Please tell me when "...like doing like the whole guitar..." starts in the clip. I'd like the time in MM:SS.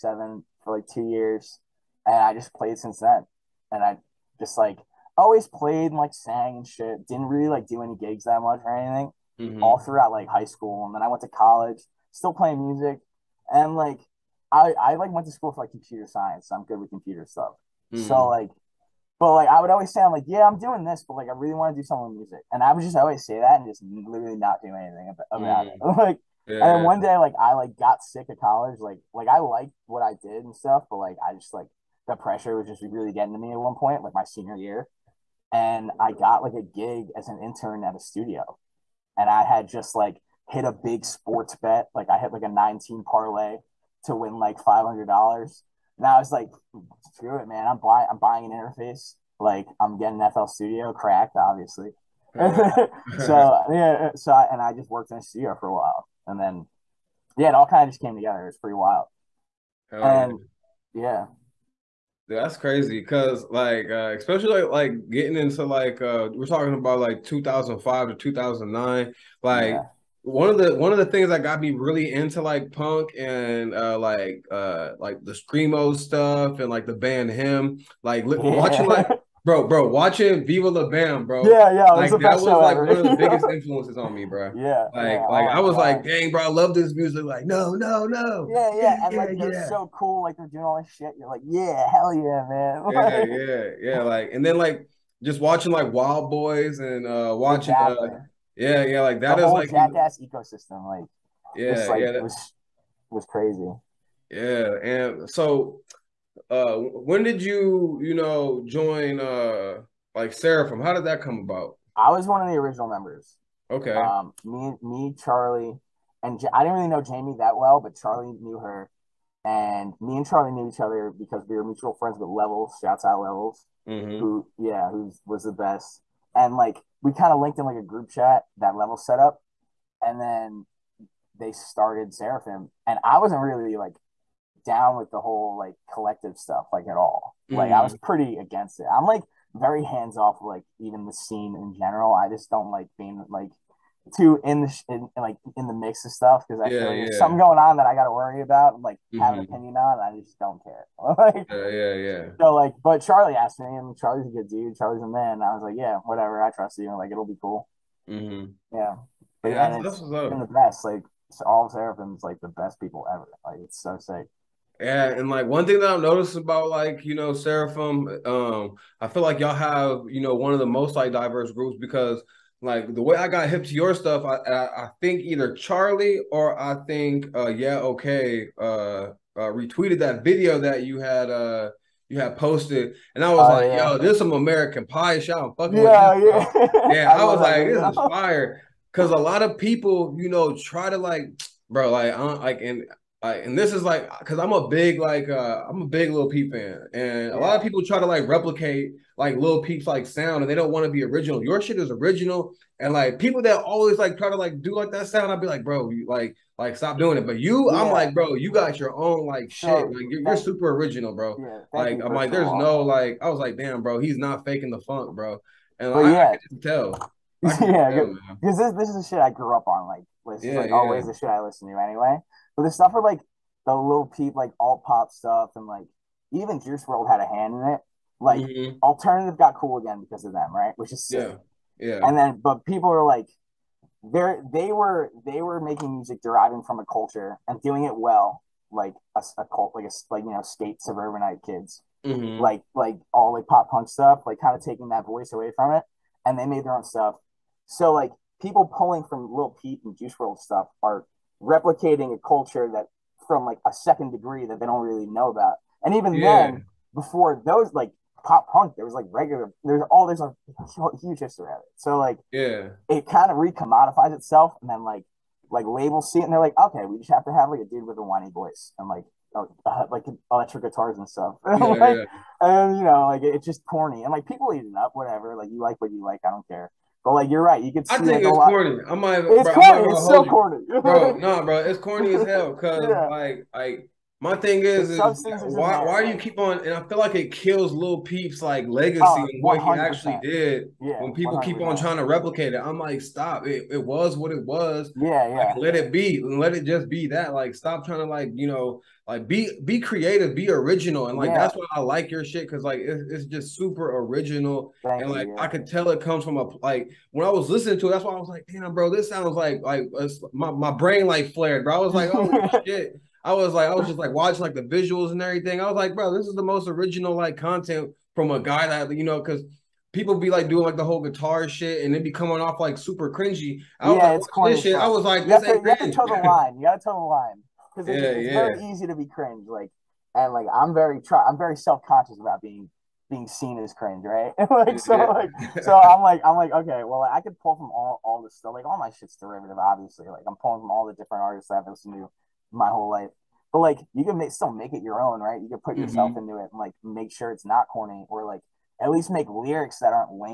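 05:20.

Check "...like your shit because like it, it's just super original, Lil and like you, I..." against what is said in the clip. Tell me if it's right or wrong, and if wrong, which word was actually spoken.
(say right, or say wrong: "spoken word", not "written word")
wrong: "Thank", not "Lil".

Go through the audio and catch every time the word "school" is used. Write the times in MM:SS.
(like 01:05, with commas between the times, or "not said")
00:10, 00:15.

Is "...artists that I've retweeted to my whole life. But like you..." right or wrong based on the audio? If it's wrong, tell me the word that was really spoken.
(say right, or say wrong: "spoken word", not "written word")
wrong: "listened", not "retweeted".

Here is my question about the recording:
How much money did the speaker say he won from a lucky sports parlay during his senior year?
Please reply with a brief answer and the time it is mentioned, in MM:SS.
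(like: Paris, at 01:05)
$500, at 00:44.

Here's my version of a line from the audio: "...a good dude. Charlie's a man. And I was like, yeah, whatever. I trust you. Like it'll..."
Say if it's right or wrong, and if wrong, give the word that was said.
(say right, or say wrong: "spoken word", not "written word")
right.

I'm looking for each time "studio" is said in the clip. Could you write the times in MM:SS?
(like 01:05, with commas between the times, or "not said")
00:37, 00:50, 00:55.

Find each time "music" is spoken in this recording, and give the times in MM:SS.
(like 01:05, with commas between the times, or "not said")
00:12, 00:22, 01:26, 03:55.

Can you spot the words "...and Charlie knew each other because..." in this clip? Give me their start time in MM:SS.
02:00.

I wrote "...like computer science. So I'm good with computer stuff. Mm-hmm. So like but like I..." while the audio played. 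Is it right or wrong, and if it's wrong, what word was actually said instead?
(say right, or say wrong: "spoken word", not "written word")
right.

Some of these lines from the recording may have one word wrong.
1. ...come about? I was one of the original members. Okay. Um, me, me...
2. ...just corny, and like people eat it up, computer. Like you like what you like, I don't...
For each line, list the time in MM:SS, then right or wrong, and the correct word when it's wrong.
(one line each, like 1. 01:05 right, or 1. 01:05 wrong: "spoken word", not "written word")
1. 01:51 right
2. 04:33 wrong: "whatever", not "computer".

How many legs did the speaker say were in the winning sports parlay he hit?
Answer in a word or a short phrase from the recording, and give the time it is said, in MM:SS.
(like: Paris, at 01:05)
19, at 00:42.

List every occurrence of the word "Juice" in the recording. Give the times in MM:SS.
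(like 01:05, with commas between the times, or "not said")
03:46, 04:09.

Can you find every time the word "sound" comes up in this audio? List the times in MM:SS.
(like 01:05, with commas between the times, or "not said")
03:20, 03:25, 05:09.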